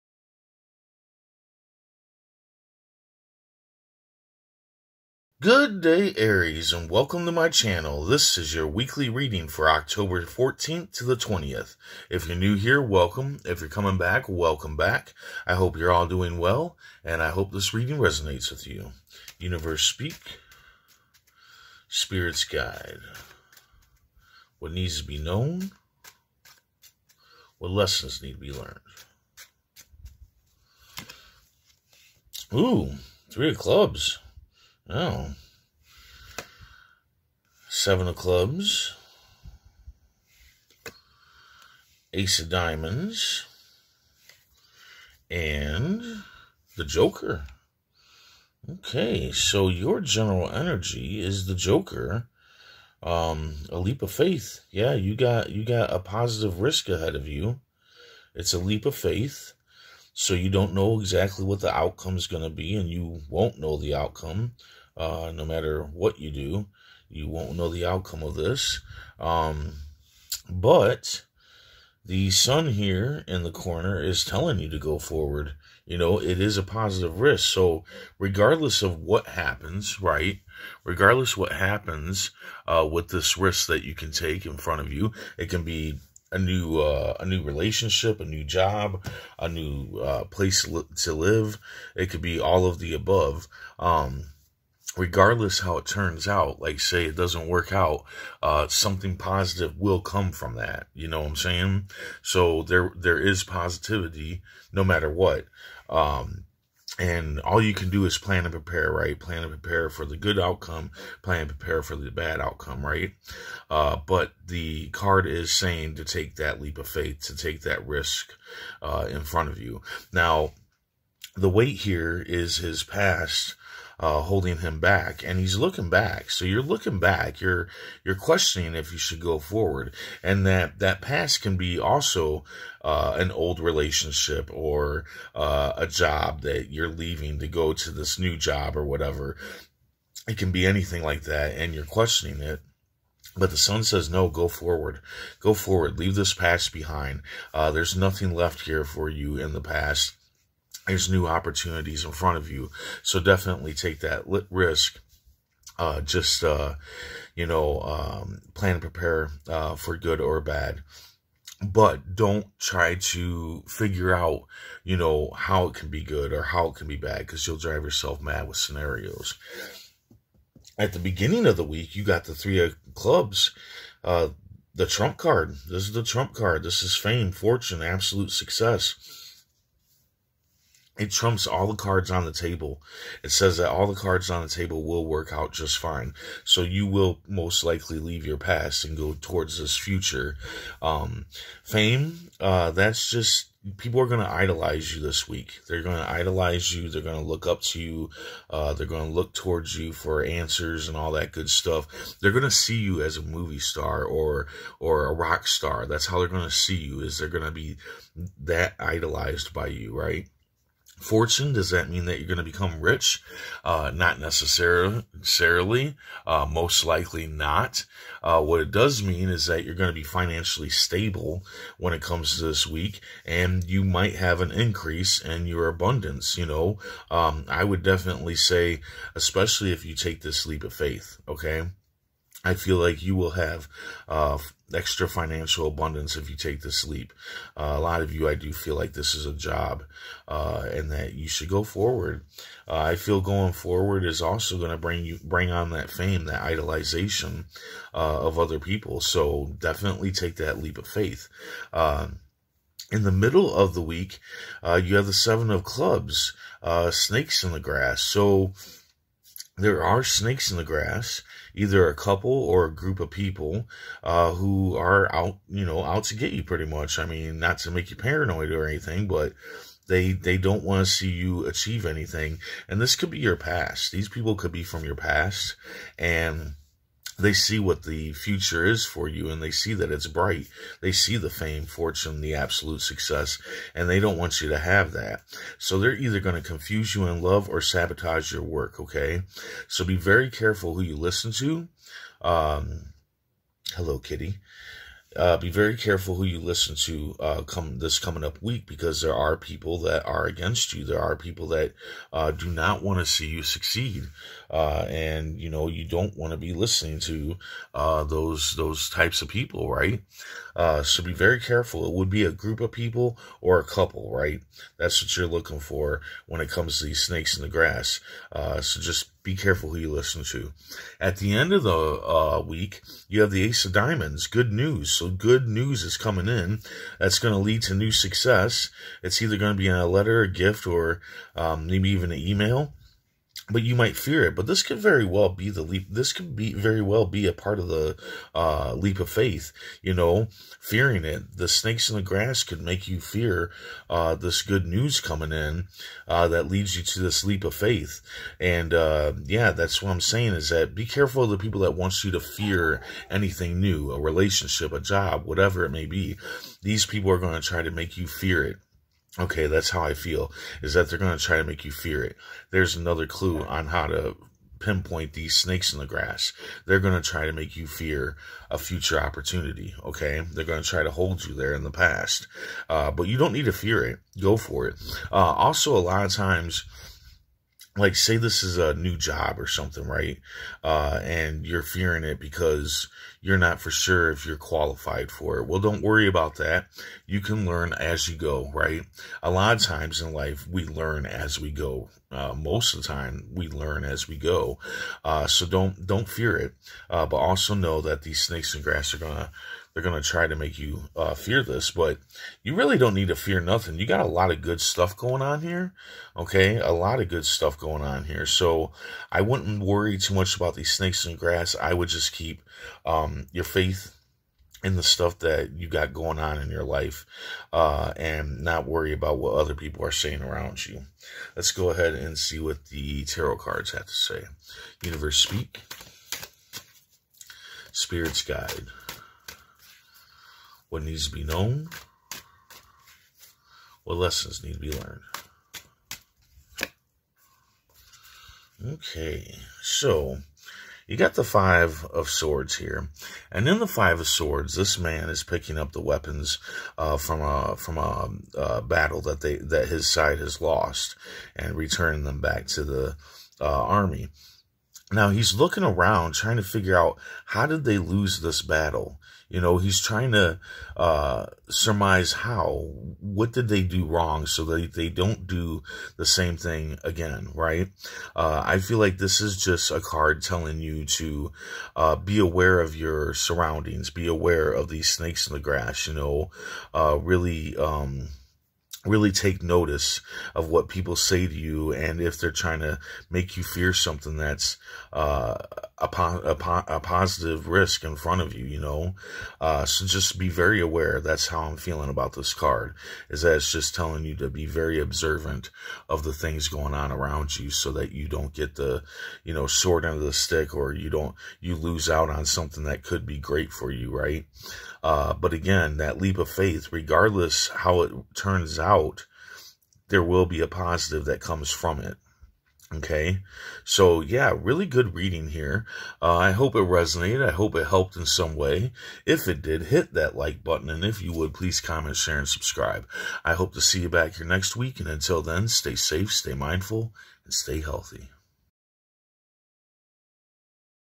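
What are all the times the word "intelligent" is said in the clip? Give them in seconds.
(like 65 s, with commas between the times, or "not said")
not said.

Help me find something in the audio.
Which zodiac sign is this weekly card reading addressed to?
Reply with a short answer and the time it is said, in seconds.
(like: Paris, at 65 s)
Aries, at 6 s.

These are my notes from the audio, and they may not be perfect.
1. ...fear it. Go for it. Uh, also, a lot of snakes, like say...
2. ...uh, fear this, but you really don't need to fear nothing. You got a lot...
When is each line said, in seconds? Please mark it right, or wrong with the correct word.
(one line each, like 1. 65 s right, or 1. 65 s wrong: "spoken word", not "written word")
1. 373 s wrong: "times", not "snakes"
2. 400 s right.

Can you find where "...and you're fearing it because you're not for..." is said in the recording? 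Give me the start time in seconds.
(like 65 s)
381 s.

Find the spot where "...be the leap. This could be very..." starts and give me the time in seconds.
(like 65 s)
335 s.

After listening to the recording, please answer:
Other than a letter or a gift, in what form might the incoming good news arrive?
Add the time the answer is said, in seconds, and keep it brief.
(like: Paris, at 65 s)
An email, at 332 s.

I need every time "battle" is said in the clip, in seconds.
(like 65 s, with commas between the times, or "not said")
448 s, 458 s.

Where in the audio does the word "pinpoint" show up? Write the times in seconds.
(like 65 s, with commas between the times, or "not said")
364 s.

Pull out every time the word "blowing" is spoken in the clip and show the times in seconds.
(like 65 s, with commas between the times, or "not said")
not said.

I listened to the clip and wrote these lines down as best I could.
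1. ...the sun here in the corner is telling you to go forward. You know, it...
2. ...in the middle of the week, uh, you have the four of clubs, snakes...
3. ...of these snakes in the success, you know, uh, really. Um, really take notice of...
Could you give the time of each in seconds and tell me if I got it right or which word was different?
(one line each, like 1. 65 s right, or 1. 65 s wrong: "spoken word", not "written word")
1. 72 s right
2. 252 s wrong: "seven", not "four"
3. 474 s wrong: "grass", not "success".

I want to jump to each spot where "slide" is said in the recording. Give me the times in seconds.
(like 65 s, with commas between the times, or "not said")
not said.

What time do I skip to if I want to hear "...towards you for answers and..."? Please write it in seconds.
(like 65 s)
199 s.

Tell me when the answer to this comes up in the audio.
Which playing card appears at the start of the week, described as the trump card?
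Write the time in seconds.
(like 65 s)
172 s.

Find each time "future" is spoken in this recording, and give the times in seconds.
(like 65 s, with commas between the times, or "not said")
189 s, 278 s, 368 s.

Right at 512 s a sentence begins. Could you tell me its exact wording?
Okay, so yeah, really good reading here.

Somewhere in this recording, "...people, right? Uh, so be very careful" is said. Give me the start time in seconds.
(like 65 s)
309 s.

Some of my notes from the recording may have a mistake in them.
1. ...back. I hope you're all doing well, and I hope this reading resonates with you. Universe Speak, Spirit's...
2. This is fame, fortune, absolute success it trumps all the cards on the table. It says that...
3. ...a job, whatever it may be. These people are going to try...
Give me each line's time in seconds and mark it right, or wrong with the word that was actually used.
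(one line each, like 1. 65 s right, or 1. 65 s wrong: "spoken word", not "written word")
1. 14 s right
2. 176 s right
3. 354 s right.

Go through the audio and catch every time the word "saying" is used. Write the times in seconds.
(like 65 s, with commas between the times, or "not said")
101 s, 115 s, 350 s, 419 s.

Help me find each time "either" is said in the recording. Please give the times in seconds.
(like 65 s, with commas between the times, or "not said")
261 s, 285 s, 329 s.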